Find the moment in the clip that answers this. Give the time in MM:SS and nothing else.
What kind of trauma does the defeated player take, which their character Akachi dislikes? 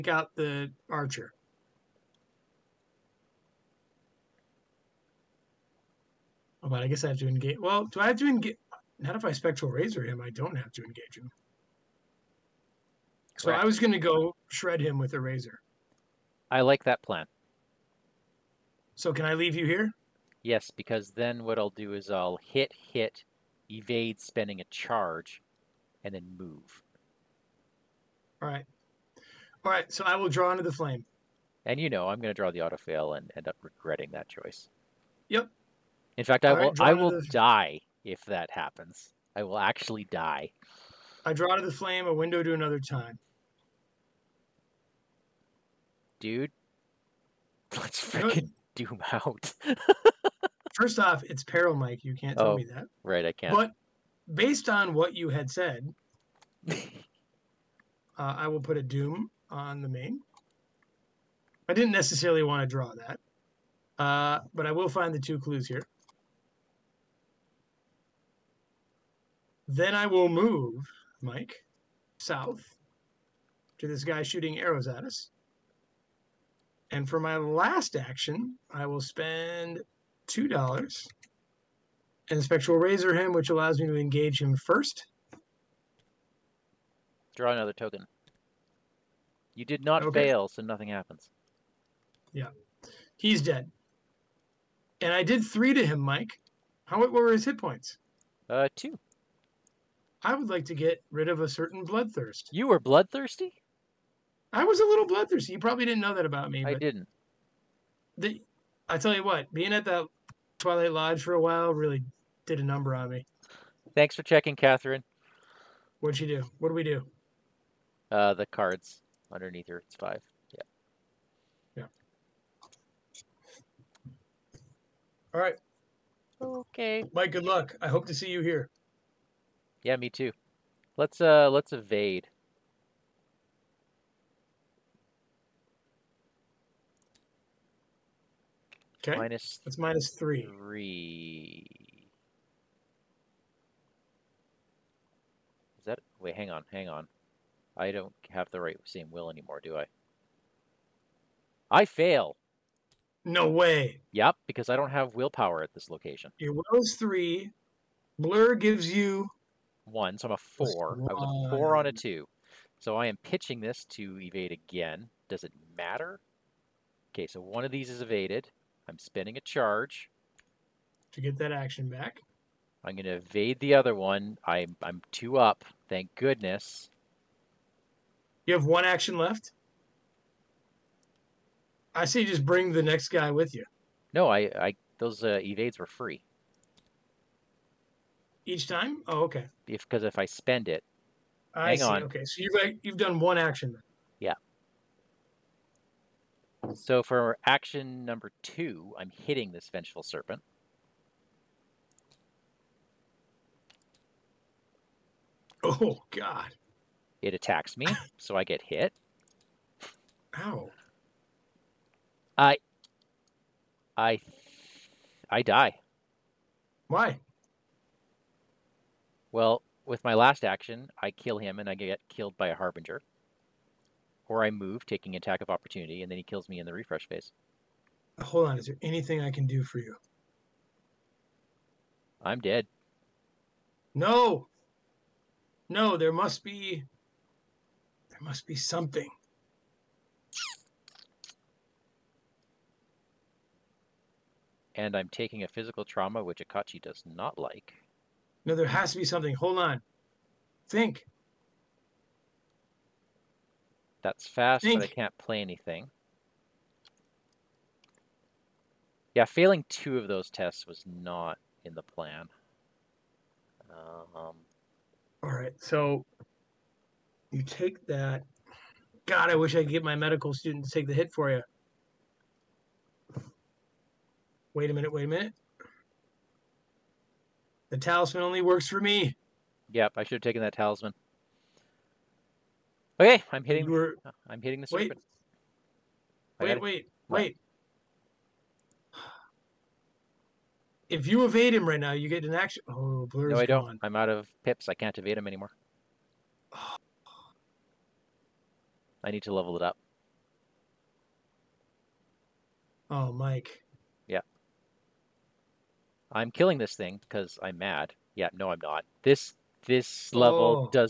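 04:05.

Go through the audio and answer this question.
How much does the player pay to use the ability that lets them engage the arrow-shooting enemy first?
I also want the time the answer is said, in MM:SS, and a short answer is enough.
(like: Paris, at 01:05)
$2, at 01:20.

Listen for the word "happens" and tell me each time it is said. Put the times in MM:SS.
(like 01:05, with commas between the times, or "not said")
00:38, 01:30.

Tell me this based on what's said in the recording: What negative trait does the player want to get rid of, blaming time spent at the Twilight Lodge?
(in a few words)
bloodthirst.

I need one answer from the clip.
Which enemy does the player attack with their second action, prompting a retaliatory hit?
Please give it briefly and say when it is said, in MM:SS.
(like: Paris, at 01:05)
Vengeful Serpent, at 03:19.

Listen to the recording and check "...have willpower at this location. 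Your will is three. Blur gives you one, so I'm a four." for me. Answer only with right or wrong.
right.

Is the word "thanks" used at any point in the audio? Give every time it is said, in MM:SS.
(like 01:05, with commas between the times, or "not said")
01:53, 02:55.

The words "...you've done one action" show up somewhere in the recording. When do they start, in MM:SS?
03:12.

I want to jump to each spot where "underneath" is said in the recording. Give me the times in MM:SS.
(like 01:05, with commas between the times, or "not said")
01:59.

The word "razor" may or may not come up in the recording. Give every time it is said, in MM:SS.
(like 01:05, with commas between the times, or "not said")
00:09, 00:15, 01:22.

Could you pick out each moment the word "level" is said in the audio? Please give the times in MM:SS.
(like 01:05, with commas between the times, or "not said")
04:59, 05:10.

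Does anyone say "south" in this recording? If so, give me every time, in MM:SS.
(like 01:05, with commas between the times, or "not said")
01:12.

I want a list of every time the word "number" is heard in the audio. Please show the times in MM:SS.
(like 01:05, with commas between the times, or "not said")
01:52, 03:18.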